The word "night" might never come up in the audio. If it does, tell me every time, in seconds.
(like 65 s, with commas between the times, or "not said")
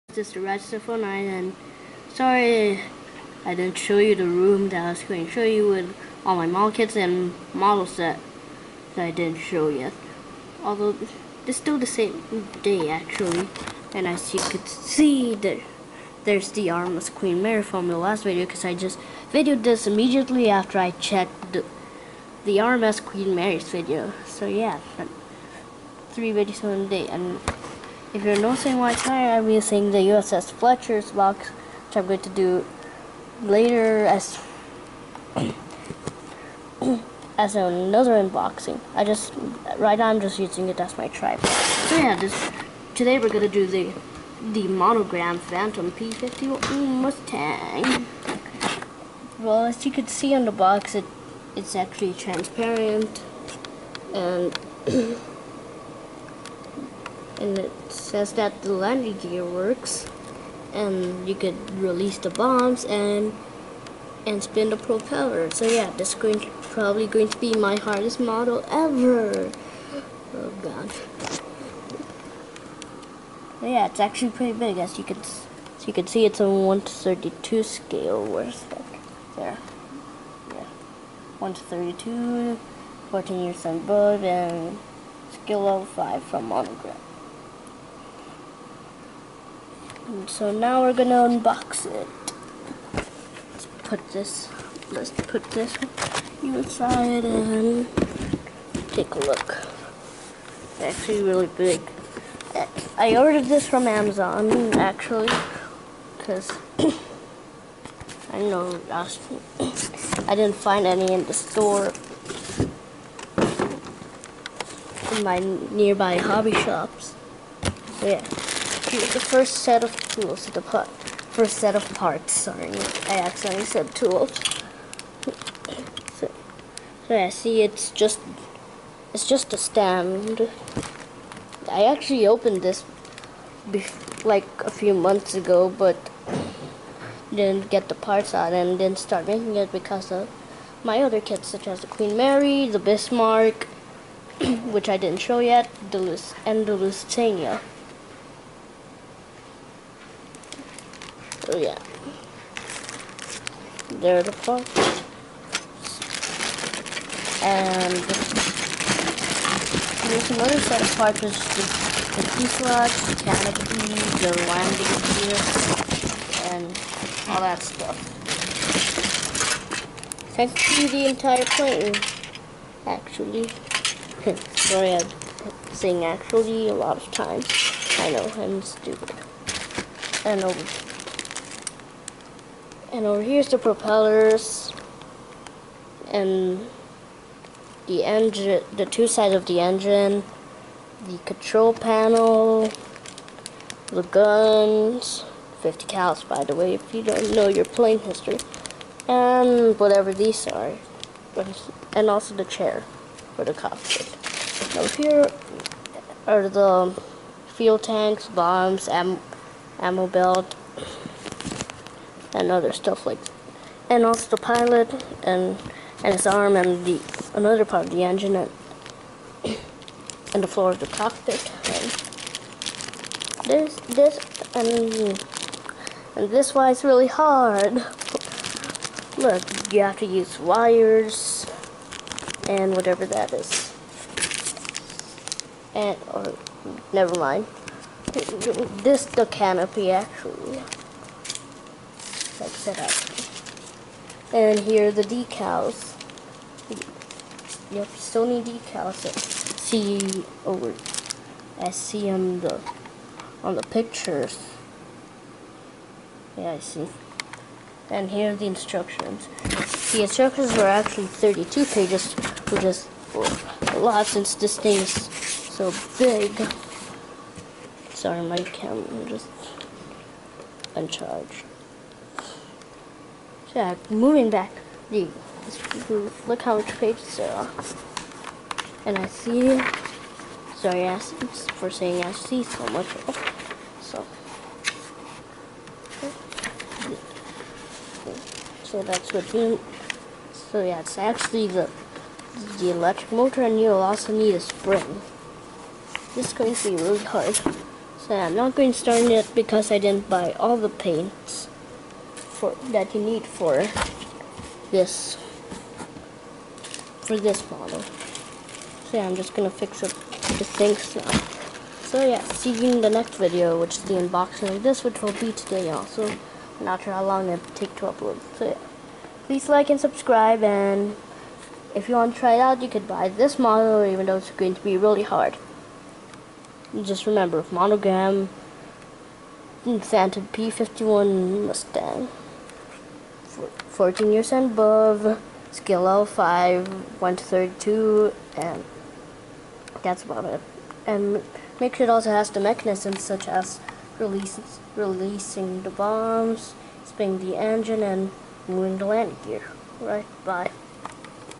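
0 s.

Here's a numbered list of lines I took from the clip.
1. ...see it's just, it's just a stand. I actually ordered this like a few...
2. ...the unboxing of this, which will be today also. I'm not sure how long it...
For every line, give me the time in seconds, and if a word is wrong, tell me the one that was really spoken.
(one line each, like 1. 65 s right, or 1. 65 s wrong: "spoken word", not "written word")
1. 127 s wrong: "opened", not "ordered"
2. 313 s right.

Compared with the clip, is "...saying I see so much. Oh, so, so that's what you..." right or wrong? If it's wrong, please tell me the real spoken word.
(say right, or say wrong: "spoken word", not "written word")
right.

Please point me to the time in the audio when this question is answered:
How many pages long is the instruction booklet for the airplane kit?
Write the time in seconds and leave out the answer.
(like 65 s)
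261 s.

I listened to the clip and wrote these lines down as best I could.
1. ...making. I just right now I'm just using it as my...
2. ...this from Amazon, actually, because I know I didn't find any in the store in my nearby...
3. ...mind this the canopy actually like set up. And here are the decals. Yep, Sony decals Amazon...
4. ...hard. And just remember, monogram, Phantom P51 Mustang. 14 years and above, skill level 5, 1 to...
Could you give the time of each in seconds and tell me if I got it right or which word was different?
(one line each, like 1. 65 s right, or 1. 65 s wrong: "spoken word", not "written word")
1. 38 s wrong: "unboxing", not "making"
2. 103 s right
3. 237 s wrong: "See", not "Amazon"
4. 325 s right.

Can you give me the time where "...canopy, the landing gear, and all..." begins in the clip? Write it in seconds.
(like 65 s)
163 s.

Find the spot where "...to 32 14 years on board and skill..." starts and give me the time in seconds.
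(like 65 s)
81 s.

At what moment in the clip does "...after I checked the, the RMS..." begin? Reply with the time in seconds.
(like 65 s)
20 s.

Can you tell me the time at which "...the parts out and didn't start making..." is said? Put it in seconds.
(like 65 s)
137 s.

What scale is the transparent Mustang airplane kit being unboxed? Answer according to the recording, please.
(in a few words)
1:32.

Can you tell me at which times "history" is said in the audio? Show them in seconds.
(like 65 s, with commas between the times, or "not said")
197 s.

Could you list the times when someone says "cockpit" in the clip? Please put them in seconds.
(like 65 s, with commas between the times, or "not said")
203 s, 220 s.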